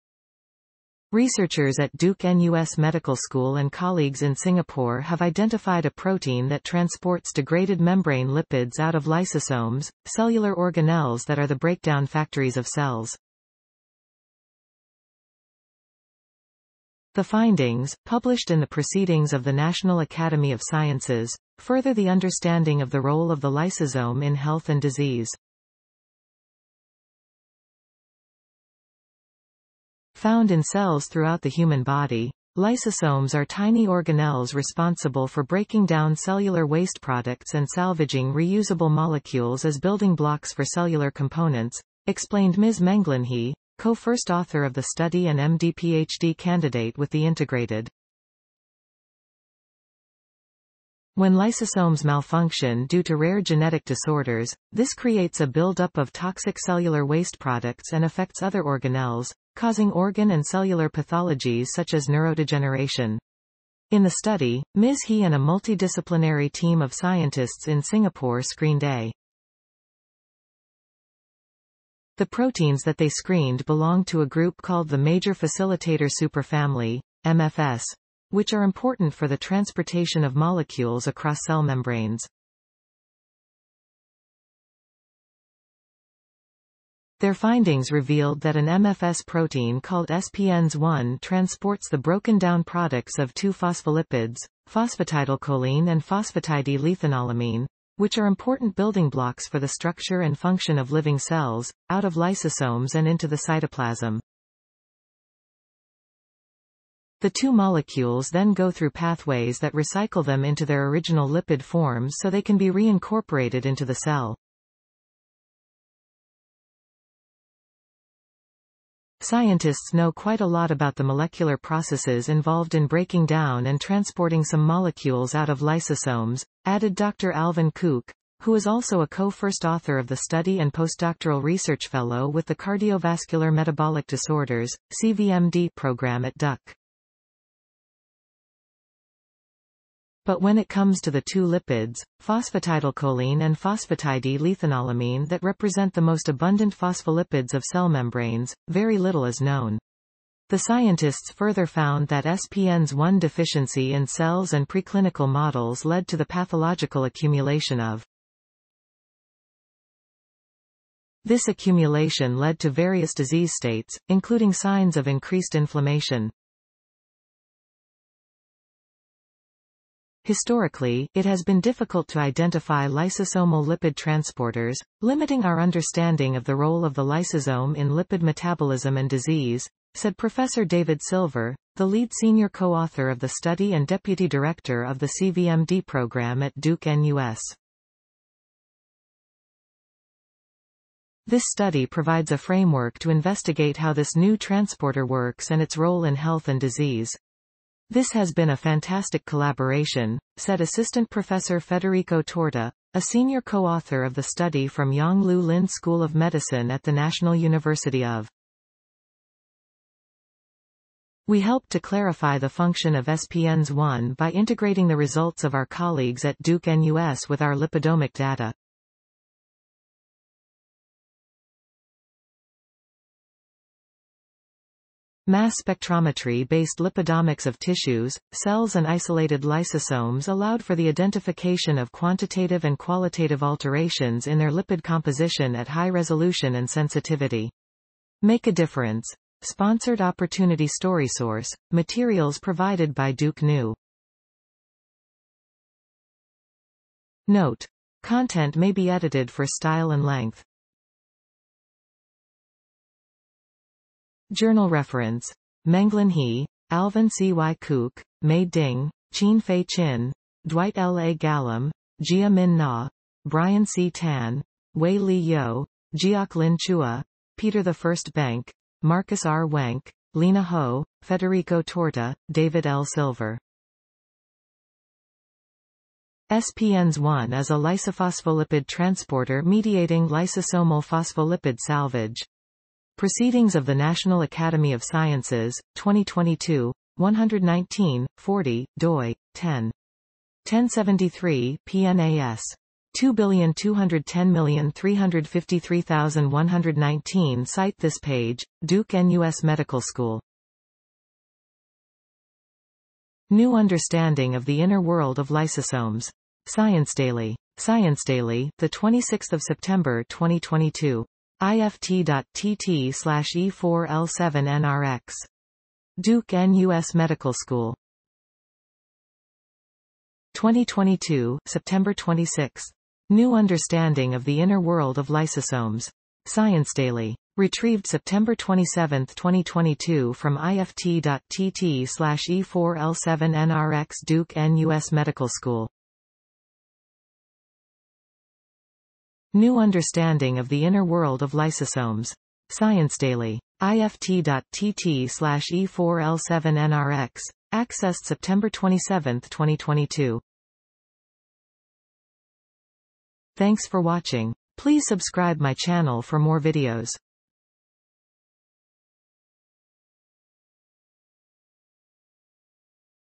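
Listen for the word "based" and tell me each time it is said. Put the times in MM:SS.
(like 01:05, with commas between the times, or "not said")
03:45.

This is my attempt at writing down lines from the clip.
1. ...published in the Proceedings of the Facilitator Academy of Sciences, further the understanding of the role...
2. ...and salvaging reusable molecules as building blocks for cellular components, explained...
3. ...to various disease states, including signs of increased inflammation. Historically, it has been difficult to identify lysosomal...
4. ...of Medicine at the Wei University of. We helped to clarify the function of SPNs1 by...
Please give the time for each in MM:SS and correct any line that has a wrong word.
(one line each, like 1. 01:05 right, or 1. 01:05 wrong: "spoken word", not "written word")
1. 00:18 wrong: "National", not "Facilitator"
2. 00:37 right
3. 02:42 right
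4. 03:26 wrong: "National", not "Wei".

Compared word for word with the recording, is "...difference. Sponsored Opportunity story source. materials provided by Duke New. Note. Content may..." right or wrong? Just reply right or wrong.
right.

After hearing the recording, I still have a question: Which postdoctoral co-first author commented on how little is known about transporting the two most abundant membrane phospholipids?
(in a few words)
Alvin Kuk.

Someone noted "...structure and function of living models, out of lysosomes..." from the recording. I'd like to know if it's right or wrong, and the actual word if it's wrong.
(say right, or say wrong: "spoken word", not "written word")
wrong: "cells", not "models".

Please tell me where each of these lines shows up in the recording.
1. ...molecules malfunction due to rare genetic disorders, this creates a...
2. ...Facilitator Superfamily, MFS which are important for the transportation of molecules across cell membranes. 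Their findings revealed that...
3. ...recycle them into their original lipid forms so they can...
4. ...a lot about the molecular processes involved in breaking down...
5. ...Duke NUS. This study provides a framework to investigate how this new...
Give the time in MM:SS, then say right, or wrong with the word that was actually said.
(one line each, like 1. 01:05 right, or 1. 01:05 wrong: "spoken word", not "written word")
1. 00:51 wrong: "lysosomes", not "molecules"
2. 01:15 right
3. 01:49 right
4. 02:00 right
5. 03:06 right.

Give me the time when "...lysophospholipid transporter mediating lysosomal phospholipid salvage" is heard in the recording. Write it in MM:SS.
04:37.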